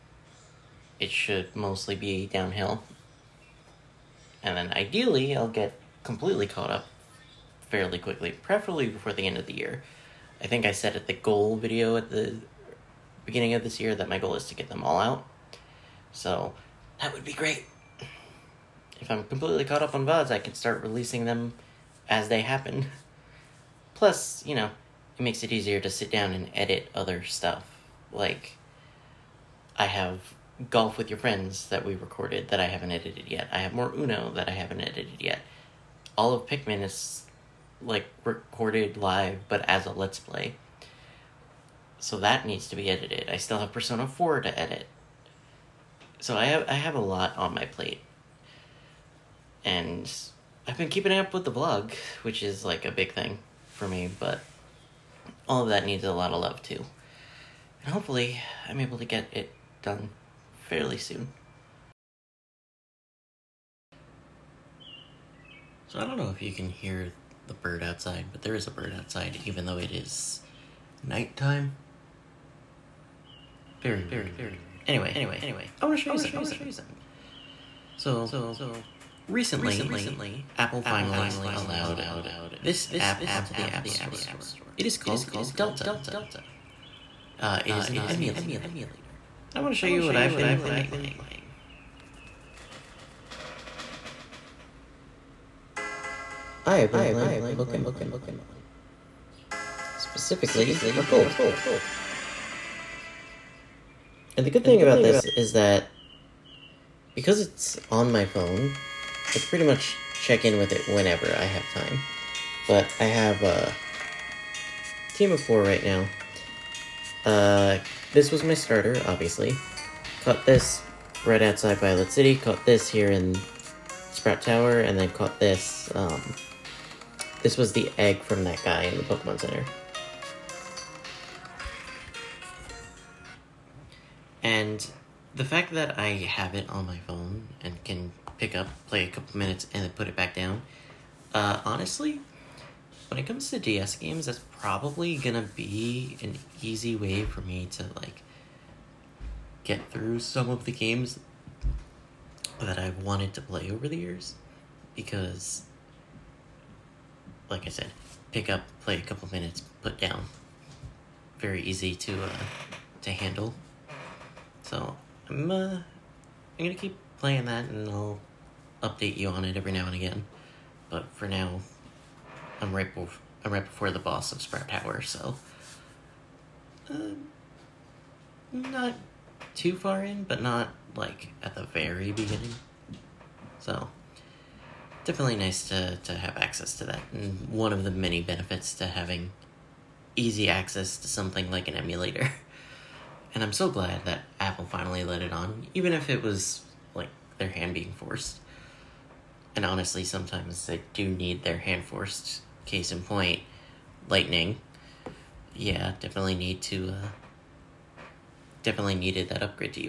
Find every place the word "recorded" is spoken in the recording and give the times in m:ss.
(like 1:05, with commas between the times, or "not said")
0:31, 0:38.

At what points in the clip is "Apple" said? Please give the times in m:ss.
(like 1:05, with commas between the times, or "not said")
1:20, 3:14.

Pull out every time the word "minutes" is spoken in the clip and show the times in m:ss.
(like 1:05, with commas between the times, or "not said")
2:19, 2:39.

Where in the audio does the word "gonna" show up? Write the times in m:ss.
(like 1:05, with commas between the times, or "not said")
2:25, 2:46.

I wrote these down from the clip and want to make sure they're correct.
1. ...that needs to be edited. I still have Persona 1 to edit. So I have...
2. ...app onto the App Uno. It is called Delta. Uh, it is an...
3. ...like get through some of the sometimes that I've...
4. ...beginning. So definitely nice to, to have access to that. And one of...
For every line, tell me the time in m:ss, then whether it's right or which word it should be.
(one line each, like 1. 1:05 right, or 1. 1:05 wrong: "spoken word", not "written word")
1. 0:42 wrong: "4", not "1"
2. 1:22 wrong: "Store", not "Uno"
3. 2:27 wrong: "games", not "sometimes"
4. 3:02 right.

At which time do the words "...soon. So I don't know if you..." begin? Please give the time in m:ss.
1:00.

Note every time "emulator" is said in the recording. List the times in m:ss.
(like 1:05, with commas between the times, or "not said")
1:28, 3:11.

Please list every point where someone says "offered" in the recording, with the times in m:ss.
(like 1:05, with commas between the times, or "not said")
not said.